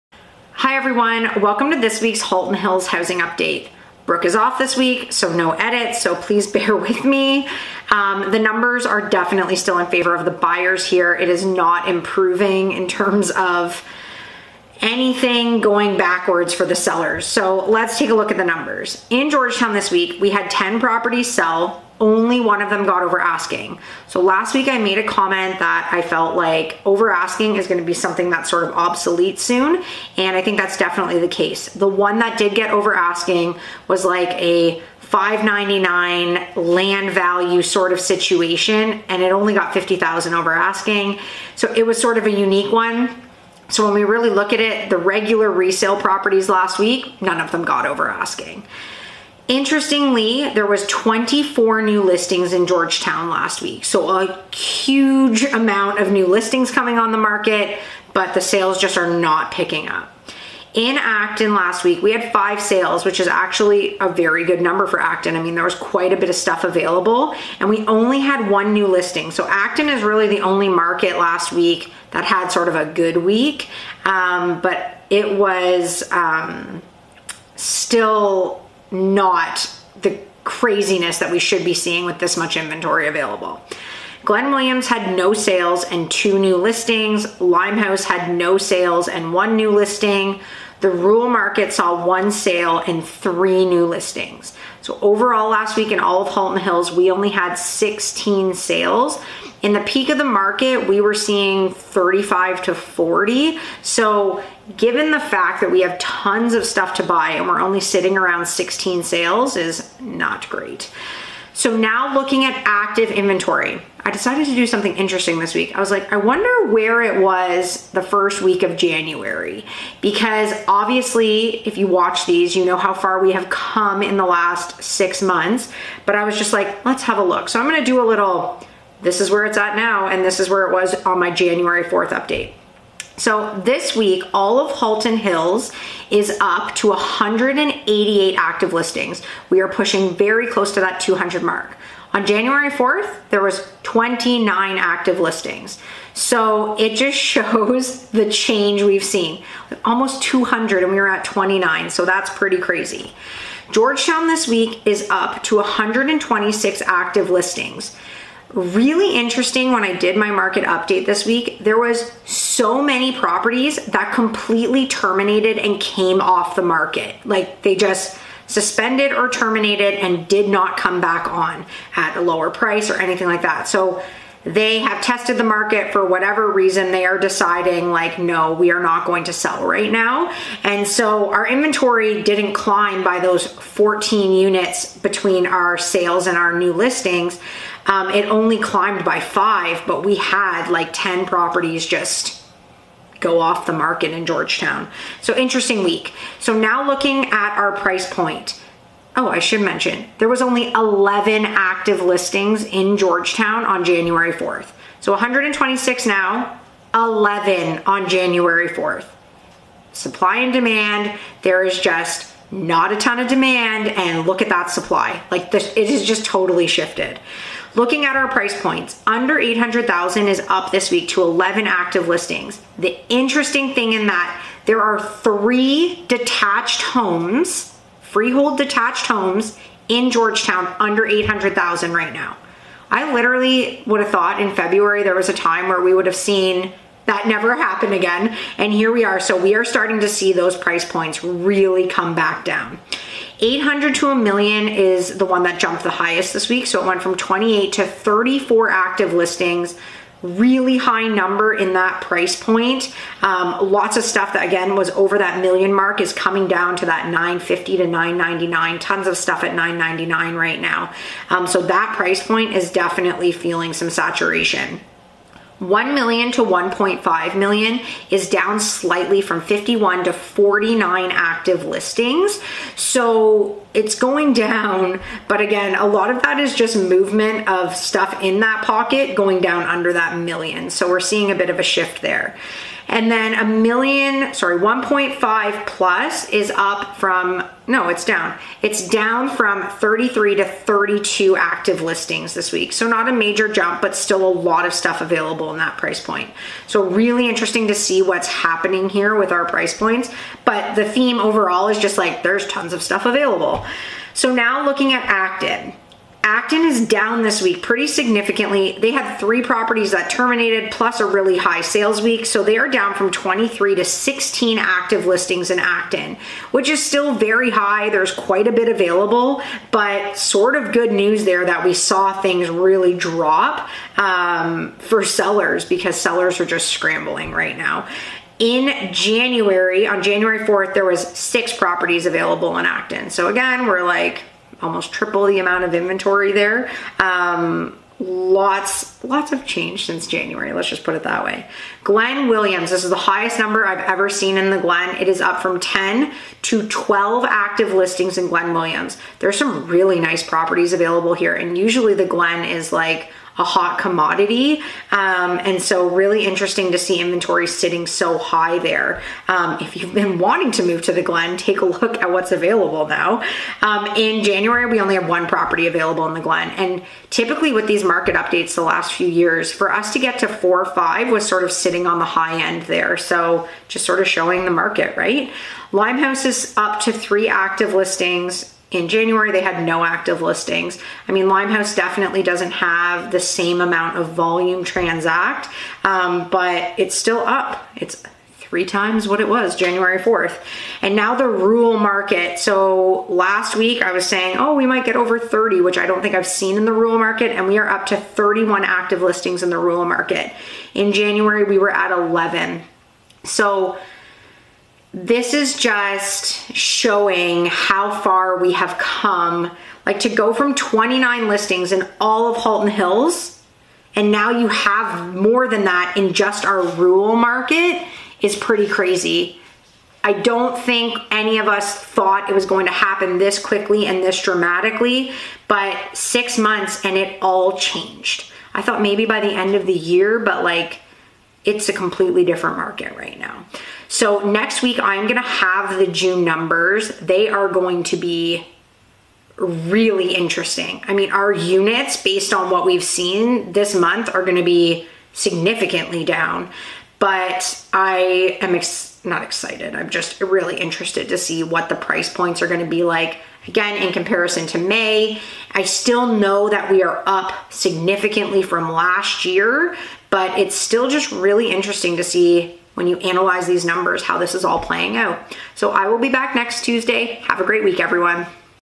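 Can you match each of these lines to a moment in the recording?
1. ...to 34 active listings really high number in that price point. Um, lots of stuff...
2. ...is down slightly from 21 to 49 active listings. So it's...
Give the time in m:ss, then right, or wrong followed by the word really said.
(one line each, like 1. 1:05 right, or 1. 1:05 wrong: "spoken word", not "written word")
1. 4:07 right
2. 4:28 wrong: "51", not "21".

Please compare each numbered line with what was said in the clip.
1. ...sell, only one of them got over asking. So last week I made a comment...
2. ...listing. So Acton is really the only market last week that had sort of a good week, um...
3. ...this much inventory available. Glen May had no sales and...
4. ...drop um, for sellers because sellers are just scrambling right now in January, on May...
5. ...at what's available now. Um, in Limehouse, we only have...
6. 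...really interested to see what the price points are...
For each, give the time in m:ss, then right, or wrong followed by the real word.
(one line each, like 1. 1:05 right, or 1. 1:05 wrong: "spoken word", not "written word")
1. 0:21 right
2. 1:08 right
3. 1:22 wrong: "Williams", not "May"
4. 5:22 wrong: "January", not "May"
5. 6:02 wrong: "January", not "Limehouse"
6. 7:30 right.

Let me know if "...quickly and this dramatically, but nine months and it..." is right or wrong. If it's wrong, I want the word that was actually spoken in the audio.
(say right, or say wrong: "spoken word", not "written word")
wrong: "six", not "nine".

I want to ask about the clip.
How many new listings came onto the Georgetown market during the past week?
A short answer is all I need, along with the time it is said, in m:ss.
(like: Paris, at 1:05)
24, at 0:50.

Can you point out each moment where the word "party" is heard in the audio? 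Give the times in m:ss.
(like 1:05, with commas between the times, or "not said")
not said.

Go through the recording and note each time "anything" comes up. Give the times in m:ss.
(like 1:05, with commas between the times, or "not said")
0:14, 2:52.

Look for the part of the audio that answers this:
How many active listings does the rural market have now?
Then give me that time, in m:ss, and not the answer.
6:37.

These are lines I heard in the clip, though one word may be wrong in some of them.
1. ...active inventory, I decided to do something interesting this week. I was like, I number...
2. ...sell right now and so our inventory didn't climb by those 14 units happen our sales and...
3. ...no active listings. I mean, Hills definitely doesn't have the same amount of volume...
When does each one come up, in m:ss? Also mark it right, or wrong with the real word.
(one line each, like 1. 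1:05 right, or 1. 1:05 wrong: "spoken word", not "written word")
1. 1:52 wrong: "wonder", not "number"
2. 2:59 wrong: "between", not "happen"
3. 6:19 wrong: "Limehouse", not "Hills".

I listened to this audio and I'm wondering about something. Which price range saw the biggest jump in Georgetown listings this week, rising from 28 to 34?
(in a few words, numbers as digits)
800,000 to 1 million.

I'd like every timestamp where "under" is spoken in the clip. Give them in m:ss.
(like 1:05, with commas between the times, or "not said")
3:39, 3:50, 4:39.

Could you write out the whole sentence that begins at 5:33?
So again, we're like almost triple the amount of inventory there.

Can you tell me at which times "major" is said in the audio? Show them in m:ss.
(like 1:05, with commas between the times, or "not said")
4:53.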